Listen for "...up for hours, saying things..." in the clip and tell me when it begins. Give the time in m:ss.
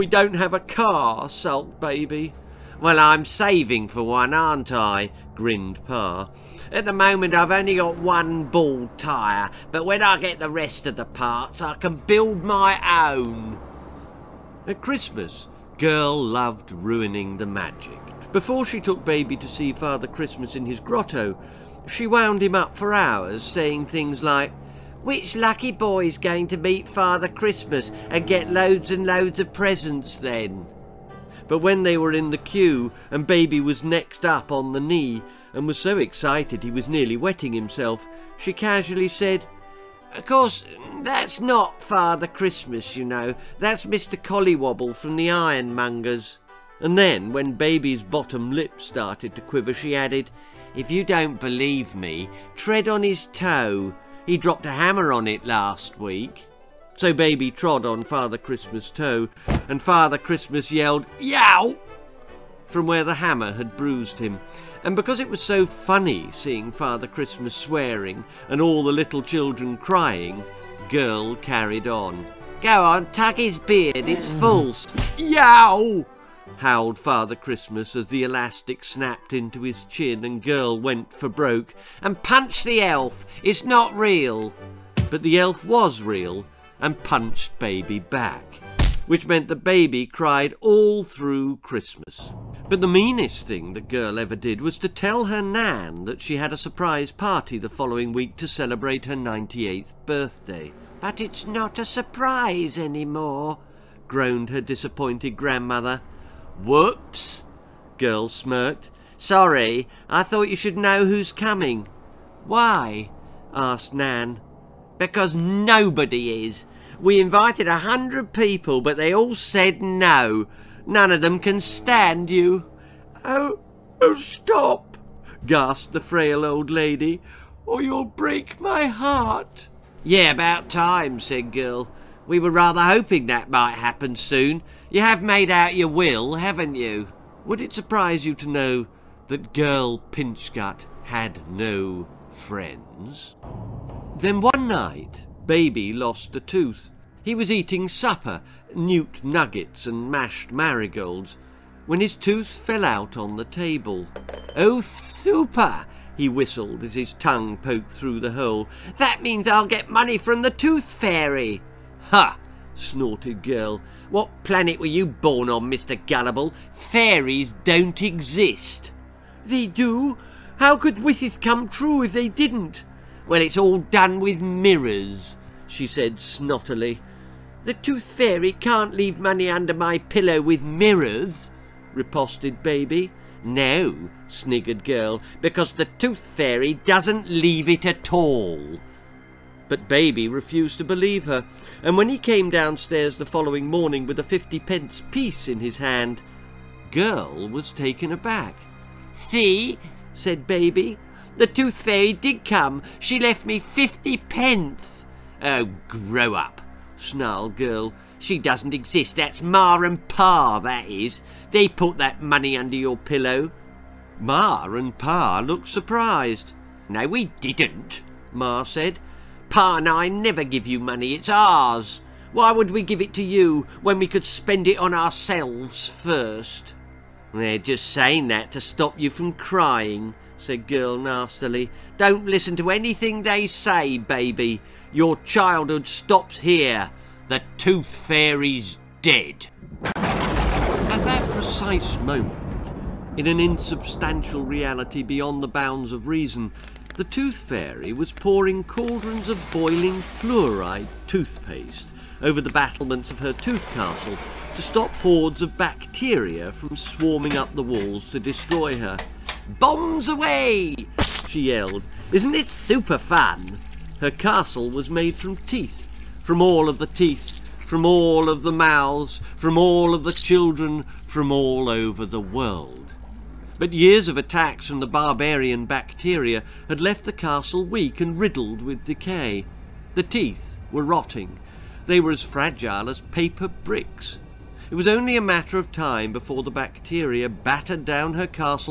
0:22.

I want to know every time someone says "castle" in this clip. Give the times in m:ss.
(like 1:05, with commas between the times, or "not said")
4:13, 4:24, 4:37.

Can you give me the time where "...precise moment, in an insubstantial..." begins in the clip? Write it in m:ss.
4:01.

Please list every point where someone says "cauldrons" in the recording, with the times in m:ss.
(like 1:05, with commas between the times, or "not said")
4:08.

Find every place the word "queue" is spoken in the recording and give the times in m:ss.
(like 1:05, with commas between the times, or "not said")
0:32.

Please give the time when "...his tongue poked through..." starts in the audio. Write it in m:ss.
2:36.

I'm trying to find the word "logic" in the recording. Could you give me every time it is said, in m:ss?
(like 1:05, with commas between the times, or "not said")
not said.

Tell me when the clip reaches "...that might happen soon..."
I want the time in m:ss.
2:13.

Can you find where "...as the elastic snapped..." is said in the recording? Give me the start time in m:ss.
1:17.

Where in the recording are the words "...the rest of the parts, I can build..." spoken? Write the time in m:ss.
0:10.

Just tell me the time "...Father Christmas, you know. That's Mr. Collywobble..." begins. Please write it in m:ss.
0:41.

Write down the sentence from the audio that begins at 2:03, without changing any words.
Oh, oh, stop, gasped the frail old lady, or you'll break my heart.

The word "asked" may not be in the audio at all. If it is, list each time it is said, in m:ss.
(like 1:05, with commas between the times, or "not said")
1:53.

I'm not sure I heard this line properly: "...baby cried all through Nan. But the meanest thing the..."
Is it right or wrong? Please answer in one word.
wrong.